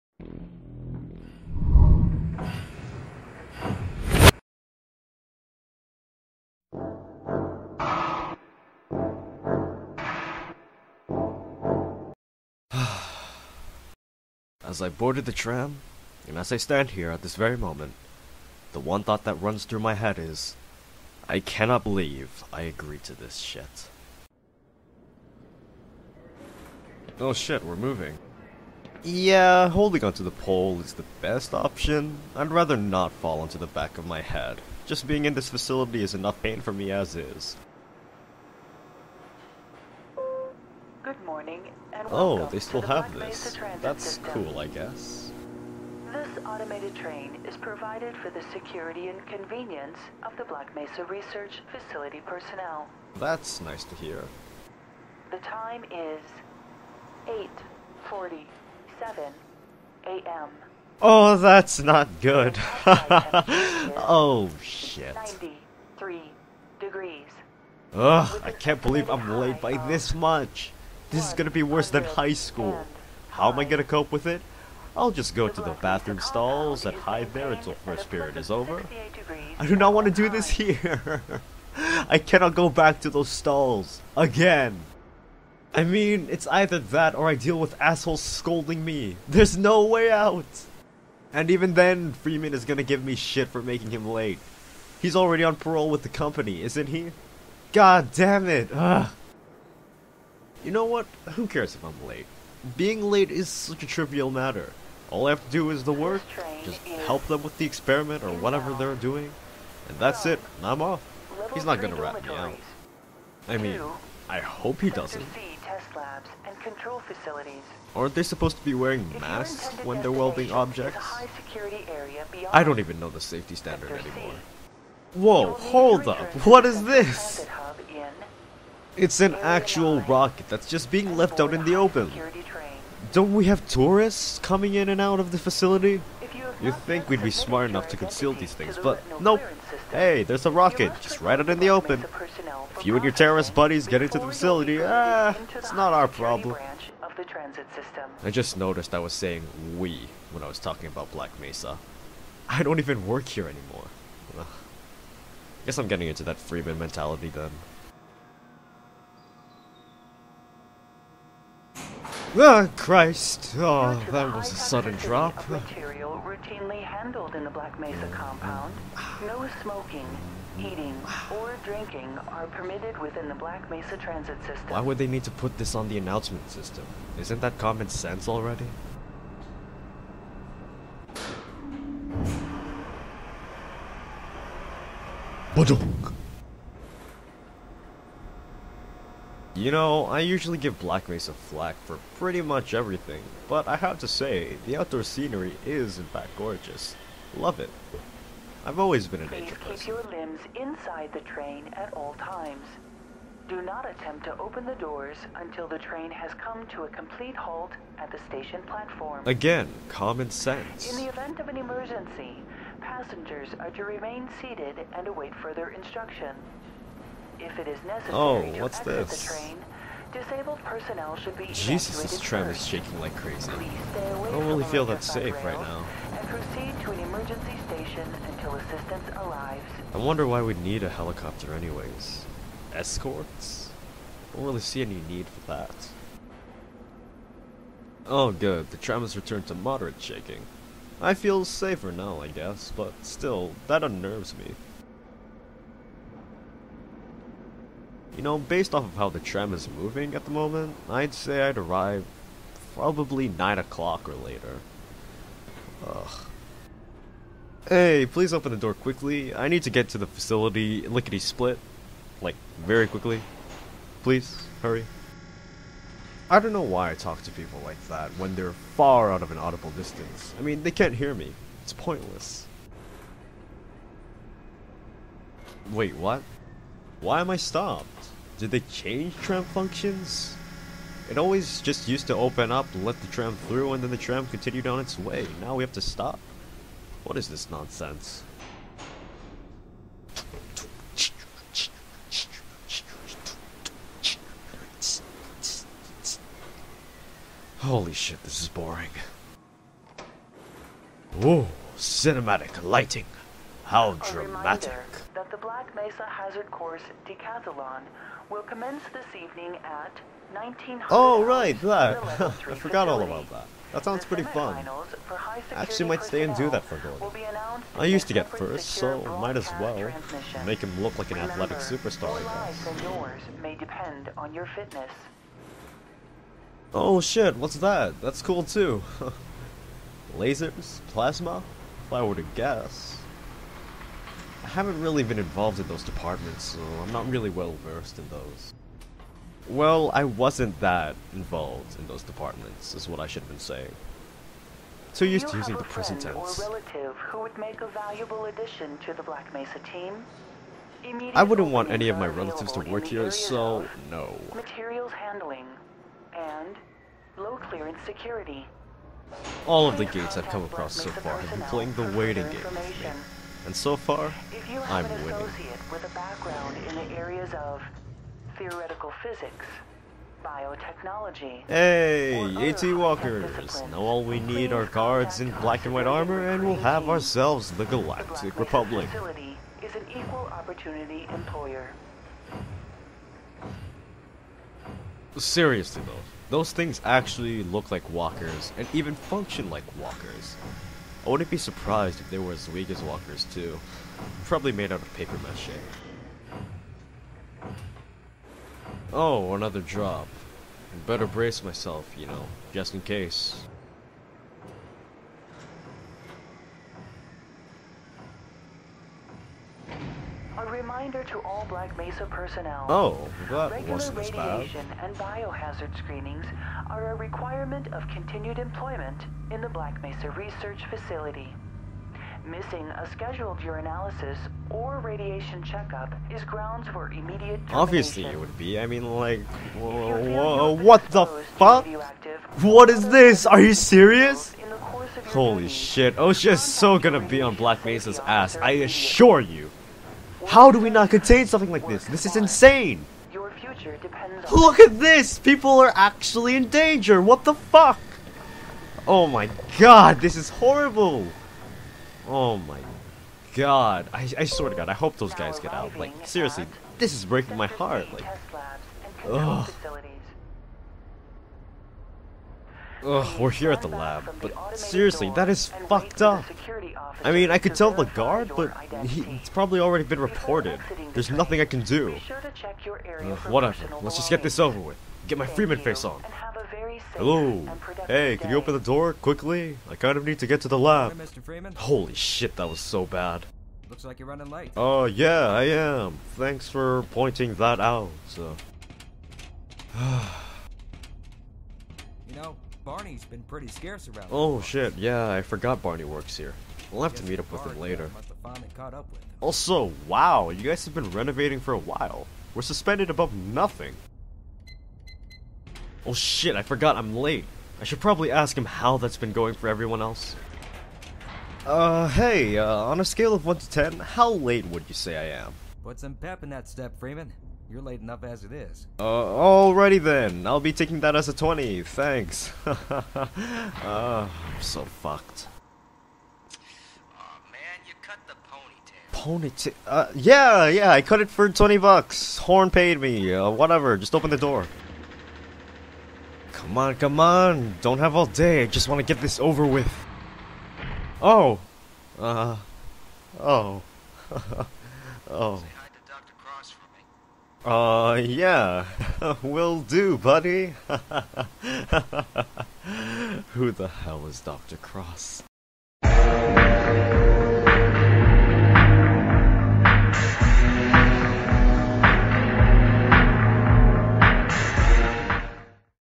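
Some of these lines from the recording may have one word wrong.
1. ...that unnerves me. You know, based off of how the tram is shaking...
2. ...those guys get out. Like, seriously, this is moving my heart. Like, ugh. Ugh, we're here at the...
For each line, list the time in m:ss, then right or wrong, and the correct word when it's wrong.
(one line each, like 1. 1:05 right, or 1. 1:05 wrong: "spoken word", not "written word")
1. 4:03 wrong: "moving", not "shaking"
2. 7:34 wrong: "breaking", not "moving".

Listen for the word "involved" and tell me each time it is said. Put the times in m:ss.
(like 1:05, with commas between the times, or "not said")
5:35, 5:41.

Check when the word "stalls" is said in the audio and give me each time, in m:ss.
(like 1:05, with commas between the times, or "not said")
1:16, 1:23.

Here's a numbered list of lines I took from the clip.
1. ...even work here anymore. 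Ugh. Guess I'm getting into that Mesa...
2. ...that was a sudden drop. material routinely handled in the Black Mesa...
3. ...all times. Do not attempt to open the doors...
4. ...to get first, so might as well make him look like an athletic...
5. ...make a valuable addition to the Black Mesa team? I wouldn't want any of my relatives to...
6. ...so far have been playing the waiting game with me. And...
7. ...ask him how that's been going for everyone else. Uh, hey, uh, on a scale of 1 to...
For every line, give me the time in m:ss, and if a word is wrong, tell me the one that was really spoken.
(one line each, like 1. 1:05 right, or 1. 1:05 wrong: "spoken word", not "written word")
1. 2:32 wrong: "Freeman", not "Mesa"
2. 2:44 right
3. 3:21 right
4. 5:18 right
5. 5:47 right
6. 6:00 right
7. 8:28 right.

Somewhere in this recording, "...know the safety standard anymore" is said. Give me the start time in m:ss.
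2:02.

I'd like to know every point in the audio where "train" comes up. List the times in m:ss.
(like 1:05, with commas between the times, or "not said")
0:46, 3:21, 3:25, 3:39.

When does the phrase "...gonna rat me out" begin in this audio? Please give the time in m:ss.
1:51.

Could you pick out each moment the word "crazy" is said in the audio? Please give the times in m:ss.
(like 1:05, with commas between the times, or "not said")
3:43.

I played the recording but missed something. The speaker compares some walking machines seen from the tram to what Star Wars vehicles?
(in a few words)
AT Walkers.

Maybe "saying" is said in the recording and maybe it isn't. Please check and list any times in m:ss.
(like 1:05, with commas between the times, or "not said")
2:29, 5:43.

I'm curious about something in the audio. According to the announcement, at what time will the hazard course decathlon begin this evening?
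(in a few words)
1900.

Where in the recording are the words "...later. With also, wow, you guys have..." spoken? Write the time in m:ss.
8:17.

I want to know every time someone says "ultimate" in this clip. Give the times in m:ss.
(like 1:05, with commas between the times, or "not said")
not said.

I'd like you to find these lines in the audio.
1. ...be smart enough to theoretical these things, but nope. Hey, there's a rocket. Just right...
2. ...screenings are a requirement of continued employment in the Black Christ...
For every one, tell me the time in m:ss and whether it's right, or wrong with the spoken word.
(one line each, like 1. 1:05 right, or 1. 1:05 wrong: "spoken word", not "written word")
1. 2:17 wrong: "conceal", not "theoretical"
2. 6:55 wrong: "Mesa", not "Christ".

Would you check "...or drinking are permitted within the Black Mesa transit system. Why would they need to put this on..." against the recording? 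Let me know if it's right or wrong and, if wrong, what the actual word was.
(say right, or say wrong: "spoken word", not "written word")
right.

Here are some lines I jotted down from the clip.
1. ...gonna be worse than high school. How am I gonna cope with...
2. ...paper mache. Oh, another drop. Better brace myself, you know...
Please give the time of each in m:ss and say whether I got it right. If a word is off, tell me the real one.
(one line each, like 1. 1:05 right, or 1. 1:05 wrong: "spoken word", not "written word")
1. 1:11 right
2. 6:34 right.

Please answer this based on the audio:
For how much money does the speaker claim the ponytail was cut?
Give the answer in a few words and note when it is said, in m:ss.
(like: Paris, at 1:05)
20 bucks, at 8:51.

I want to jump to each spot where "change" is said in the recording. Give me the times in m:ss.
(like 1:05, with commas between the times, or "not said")
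4:38.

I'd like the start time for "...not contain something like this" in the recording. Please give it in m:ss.
7:20.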